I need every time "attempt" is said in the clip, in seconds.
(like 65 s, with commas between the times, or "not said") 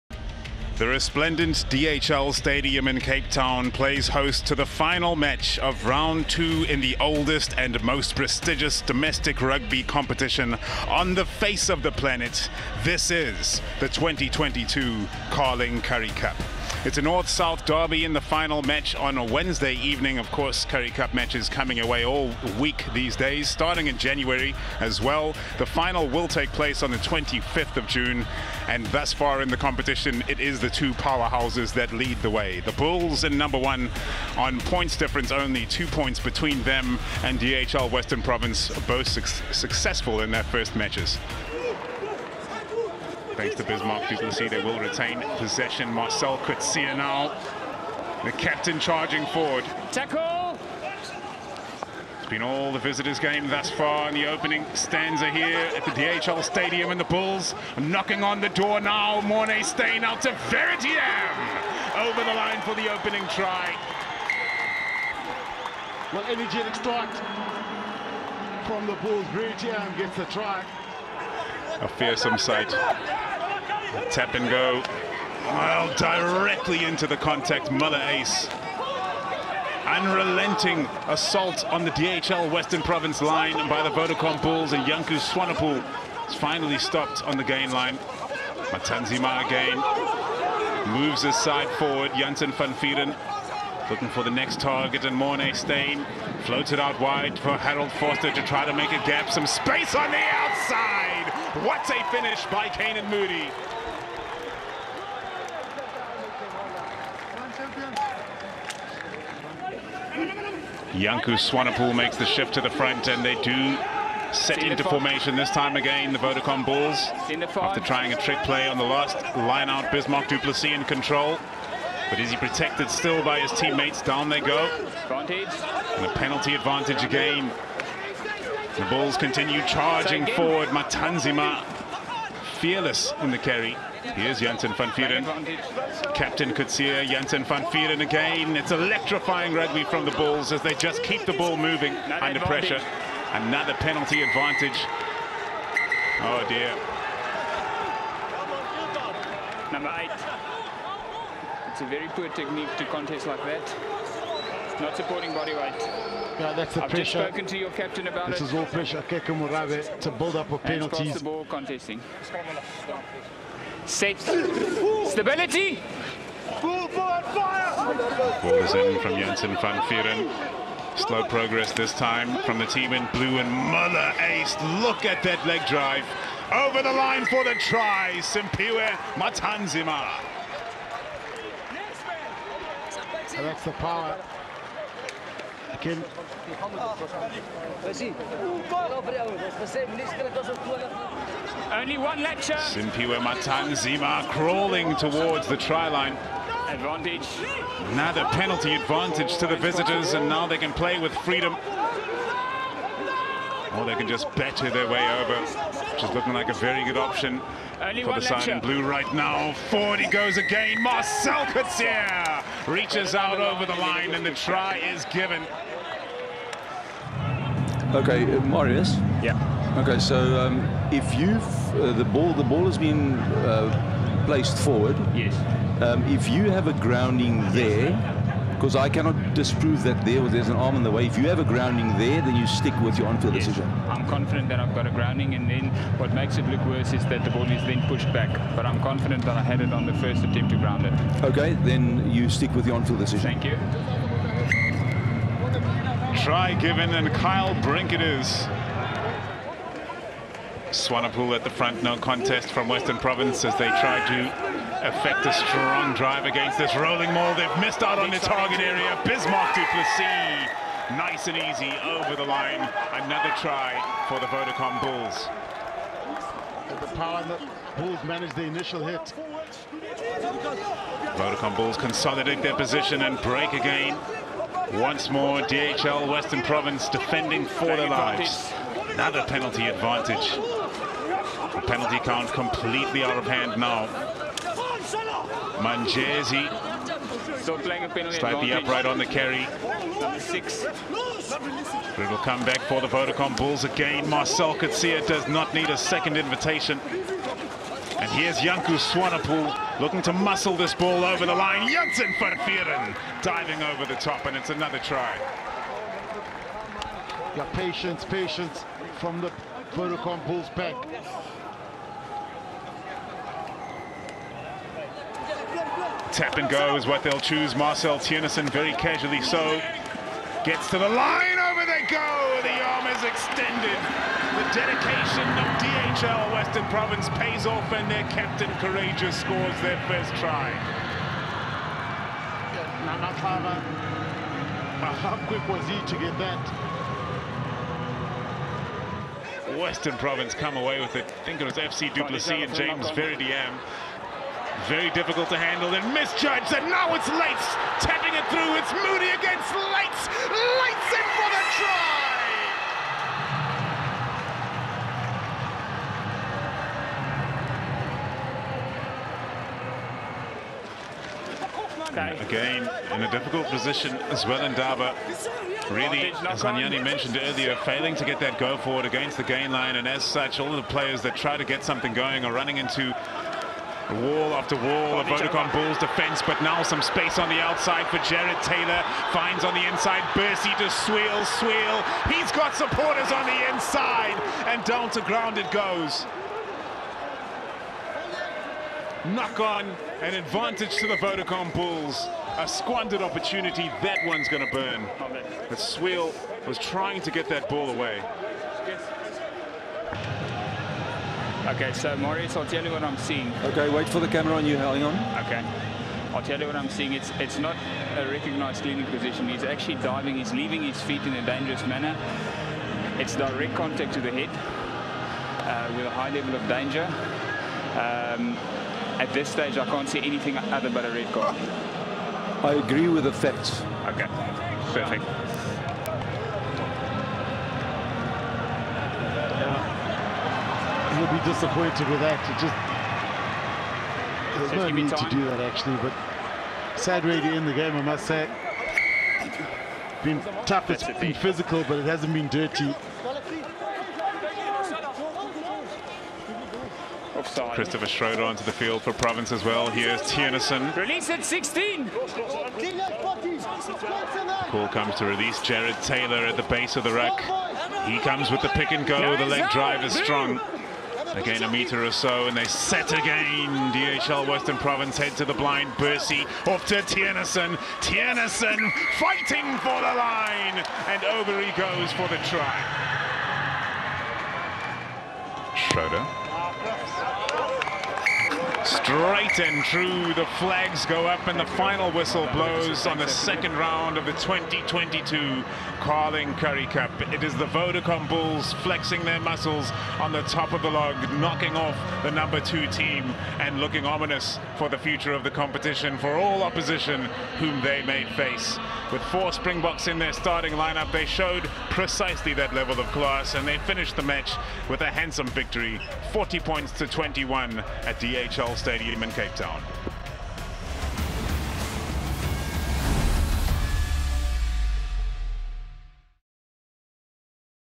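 240 s.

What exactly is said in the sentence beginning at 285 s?
Manjesi so playing a penalty slightly upright on the carry.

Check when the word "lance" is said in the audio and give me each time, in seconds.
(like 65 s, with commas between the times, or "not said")
not said.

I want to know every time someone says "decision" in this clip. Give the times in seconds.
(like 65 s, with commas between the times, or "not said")
233 s, 242 s.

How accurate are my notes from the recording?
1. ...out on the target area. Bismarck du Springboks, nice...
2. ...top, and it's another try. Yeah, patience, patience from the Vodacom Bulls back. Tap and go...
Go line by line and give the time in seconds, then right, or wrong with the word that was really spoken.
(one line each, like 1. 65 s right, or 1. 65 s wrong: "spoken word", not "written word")
1. 257 s wrong: "Plessis", not "Springboks"
2. 303 s right.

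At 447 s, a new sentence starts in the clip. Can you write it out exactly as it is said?
Christopher Schroeder onto the field for Province as well.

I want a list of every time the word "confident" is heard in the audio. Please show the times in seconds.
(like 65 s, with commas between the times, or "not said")
234 s, 238 s.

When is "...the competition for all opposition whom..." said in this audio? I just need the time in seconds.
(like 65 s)
495 s.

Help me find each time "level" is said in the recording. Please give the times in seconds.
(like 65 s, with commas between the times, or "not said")
416 s, 502 s.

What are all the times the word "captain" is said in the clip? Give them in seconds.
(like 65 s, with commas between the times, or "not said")
48 s, 136 s, 157 s, 328 s.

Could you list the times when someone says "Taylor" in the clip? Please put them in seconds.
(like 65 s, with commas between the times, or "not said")
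378 s, 455 s.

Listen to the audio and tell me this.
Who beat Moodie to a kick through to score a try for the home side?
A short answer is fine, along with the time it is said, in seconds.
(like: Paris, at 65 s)
Leyds, at 350 s.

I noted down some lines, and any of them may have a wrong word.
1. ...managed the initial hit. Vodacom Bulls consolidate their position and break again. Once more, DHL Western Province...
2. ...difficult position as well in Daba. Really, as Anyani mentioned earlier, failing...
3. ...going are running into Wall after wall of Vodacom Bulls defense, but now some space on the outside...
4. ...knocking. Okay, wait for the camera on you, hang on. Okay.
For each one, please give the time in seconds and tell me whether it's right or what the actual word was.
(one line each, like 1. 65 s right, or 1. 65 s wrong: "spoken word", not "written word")
1. 268 s right
2. 363 s right
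3. 371 s right
4. 402 s wrong: "seeing", not "knocking".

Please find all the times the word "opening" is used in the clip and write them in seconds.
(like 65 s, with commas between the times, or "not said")
54 s, 62 s.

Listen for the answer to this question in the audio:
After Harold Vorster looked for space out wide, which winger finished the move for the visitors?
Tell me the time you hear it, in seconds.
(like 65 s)
102 s.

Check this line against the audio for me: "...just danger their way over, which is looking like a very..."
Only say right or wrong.
wrong.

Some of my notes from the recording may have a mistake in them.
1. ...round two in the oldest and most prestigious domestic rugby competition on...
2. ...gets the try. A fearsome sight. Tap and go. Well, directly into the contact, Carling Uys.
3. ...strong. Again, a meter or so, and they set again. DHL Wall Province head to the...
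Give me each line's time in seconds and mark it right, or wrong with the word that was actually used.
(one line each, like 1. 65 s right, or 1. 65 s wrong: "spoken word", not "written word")
1. 5 s right
2. 69 s wrong: "Muller", not "Carling"
3. 459 s wrong: "Western", not "Wall".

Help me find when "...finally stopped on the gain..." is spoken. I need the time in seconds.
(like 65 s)
86 s.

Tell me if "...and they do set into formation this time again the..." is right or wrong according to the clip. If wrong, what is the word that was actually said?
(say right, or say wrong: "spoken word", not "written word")
right.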